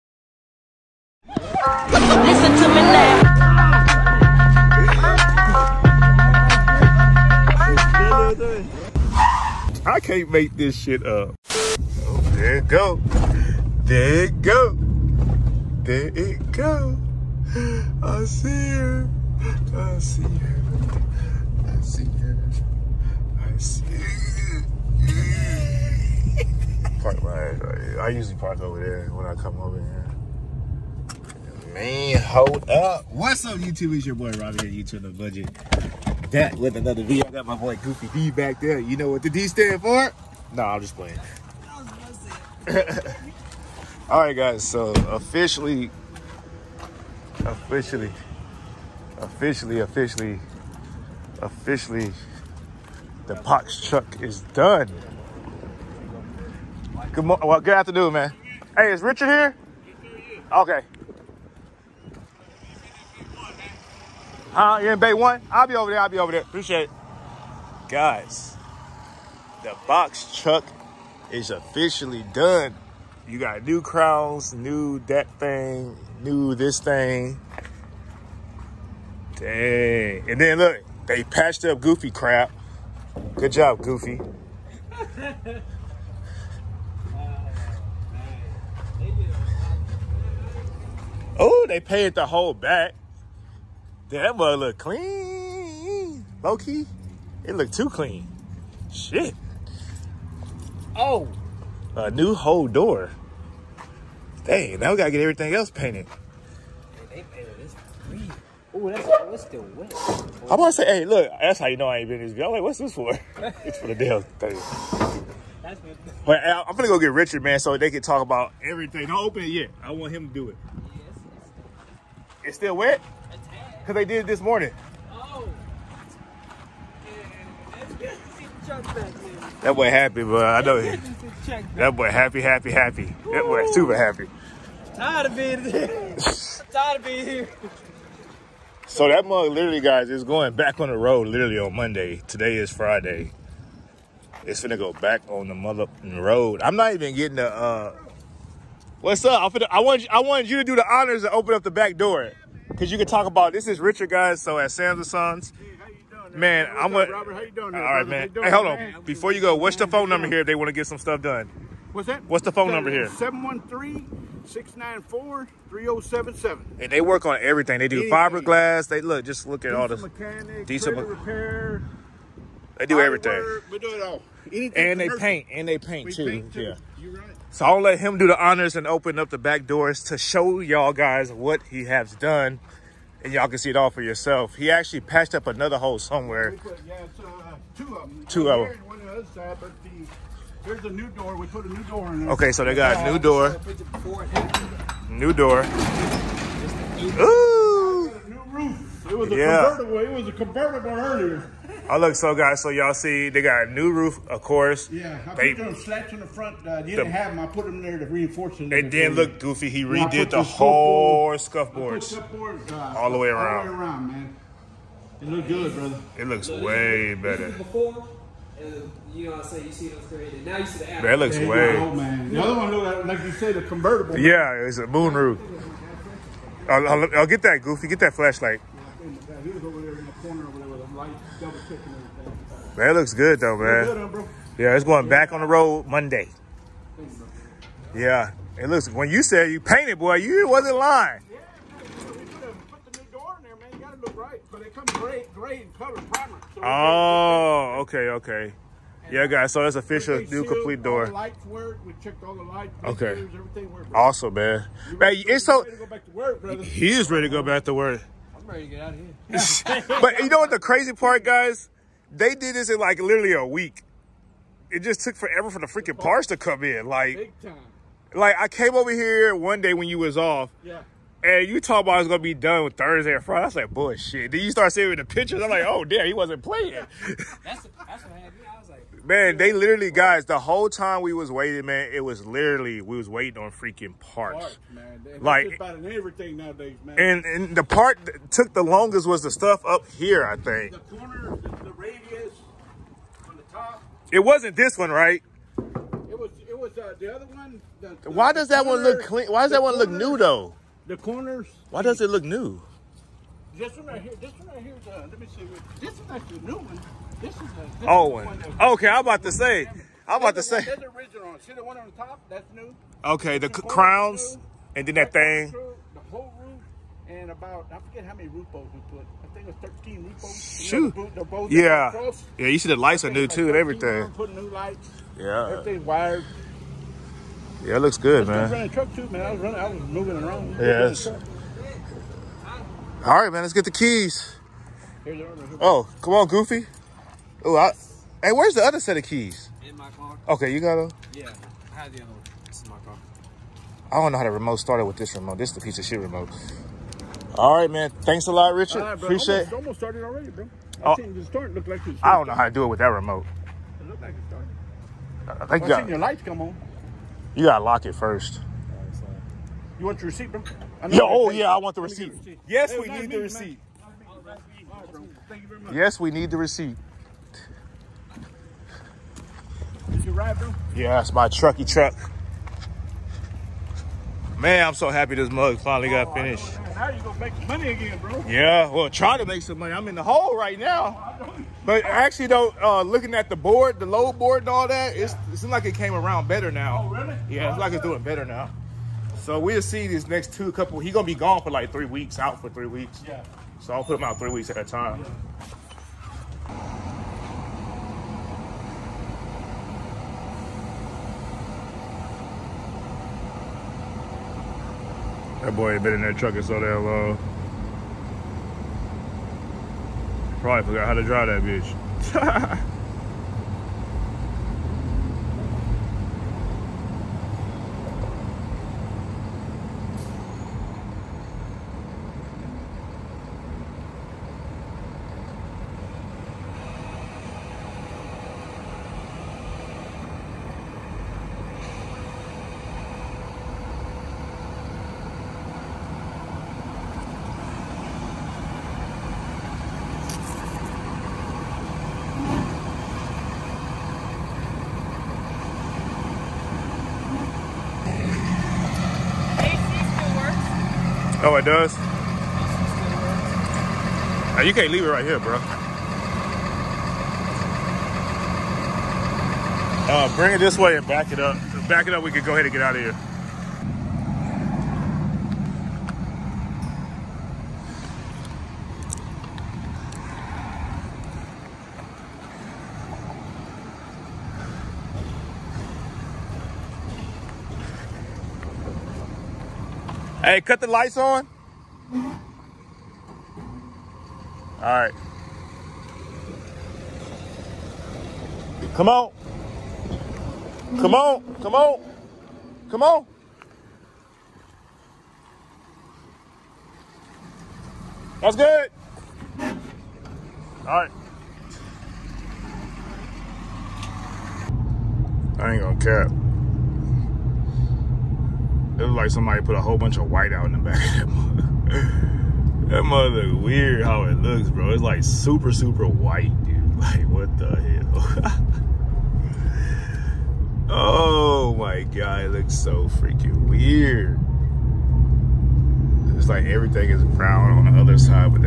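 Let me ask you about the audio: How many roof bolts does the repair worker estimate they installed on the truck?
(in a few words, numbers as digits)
13.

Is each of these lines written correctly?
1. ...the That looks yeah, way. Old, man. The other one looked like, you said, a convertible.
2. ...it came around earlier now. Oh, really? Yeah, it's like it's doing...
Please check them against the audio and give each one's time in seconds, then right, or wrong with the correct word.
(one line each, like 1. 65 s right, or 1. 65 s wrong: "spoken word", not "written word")
1. 220 s right
2. 385 s wrong: "better", not "earlier".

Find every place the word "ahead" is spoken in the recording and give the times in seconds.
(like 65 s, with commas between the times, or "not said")
462 s.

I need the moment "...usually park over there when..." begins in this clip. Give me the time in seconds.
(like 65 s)
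28 s.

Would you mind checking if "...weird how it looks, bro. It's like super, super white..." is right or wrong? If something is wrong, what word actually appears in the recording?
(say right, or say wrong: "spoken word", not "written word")
right.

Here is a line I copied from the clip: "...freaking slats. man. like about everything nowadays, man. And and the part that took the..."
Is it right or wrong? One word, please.
wrong.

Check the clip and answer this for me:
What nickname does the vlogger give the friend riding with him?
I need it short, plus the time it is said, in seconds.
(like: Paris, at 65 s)
Goofy D, at 37 s.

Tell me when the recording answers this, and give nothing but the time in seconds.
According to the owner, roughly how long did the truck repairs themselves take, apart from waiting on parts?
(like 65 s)
263 s.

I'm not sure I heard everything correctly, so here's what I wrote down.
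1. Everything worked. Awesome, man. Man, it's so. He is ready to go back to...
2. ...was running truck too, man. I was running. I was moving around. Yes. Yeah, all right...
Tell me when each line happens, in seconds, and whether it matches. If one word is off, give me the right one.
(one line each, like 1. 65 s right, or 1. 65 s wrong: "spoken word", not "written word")
1. 253 s right
2. 328 s right.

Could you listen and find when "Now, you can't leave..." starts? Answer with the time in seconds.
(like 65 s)
454 s.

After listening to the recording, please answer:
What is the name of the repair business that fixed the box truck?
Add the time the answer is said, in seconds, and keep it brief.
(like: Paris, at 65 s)
Sam's and Sons, at 154 s.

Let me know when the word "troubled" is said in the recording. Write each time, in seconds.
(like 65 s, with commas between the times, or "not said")
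not said.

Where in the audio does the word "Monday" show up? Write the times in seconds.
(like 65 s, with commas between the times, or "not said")
141 s, 235 s.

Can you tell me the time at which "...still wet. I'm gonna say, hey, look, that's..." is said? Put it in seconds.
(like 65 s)
109 s.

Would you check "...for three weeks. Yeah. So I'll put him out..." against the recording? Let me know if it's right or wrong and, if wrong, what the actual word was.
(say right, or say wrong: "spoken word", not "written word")
right.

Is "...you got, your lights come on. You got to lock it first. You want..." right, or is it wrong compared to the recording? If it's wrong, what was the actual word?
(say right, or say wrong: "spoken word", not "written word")
right.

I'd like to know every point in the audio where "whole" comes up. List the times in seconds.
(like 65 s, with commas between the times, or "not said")
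92 s, 102 s, 210 s, 280 s, 316 s, 509 s.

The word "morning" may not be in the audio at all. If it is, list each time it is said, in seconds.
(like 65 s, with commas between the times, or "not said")
57 s, 124 s.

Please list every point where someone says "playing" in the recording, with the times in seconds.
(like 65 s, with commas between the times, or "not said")
40 s, 276 s.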